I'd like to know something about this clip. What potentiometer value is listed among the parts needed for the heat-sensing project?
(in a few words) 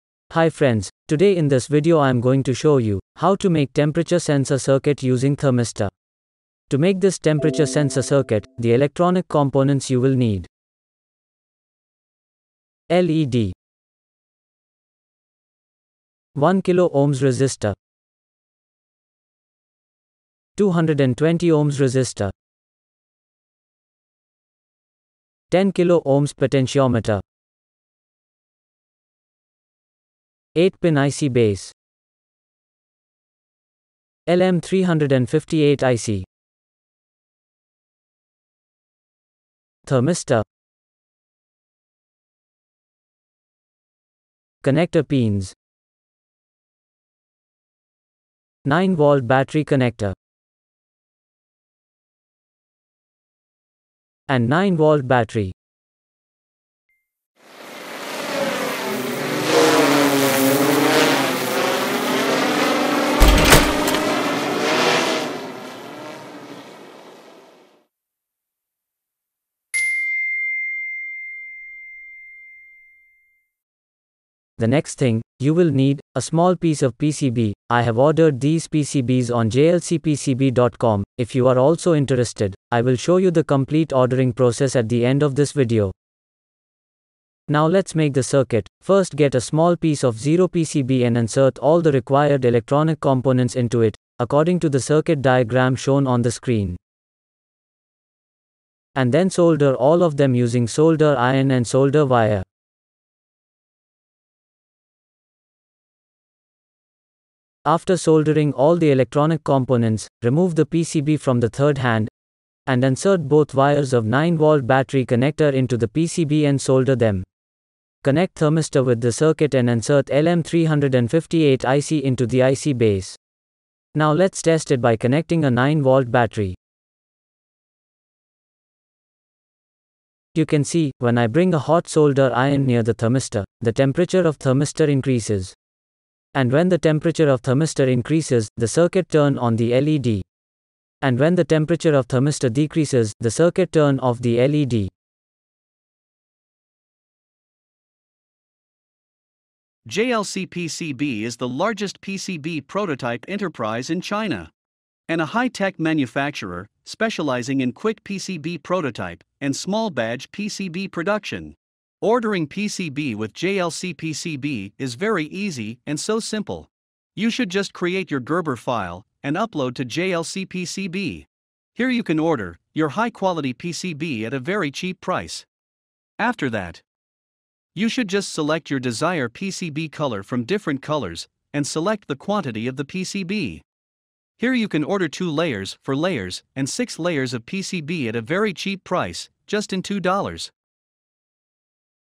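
10 kilo ohms.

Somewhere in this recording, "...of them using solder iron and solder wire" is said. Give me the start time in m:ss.
1:40.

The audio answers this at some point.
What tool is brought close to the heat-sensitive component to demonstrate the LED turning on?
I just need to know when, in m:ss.
2:11.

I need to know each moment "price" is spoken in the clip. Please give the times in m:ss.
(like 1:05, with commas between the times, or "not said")
2:54, 3:08.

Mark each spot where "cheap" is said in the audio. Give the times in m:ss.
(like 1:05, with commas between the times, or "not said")
2:54, 3:08.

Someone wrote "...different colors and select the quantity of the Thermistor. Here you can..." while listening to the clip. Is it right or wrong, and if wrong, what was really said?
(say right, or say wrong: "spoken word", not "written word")
wrong: "PCB", not "Thermistor".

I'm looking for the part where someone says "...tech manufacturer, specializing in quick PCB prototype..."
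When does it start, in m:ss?
2:35.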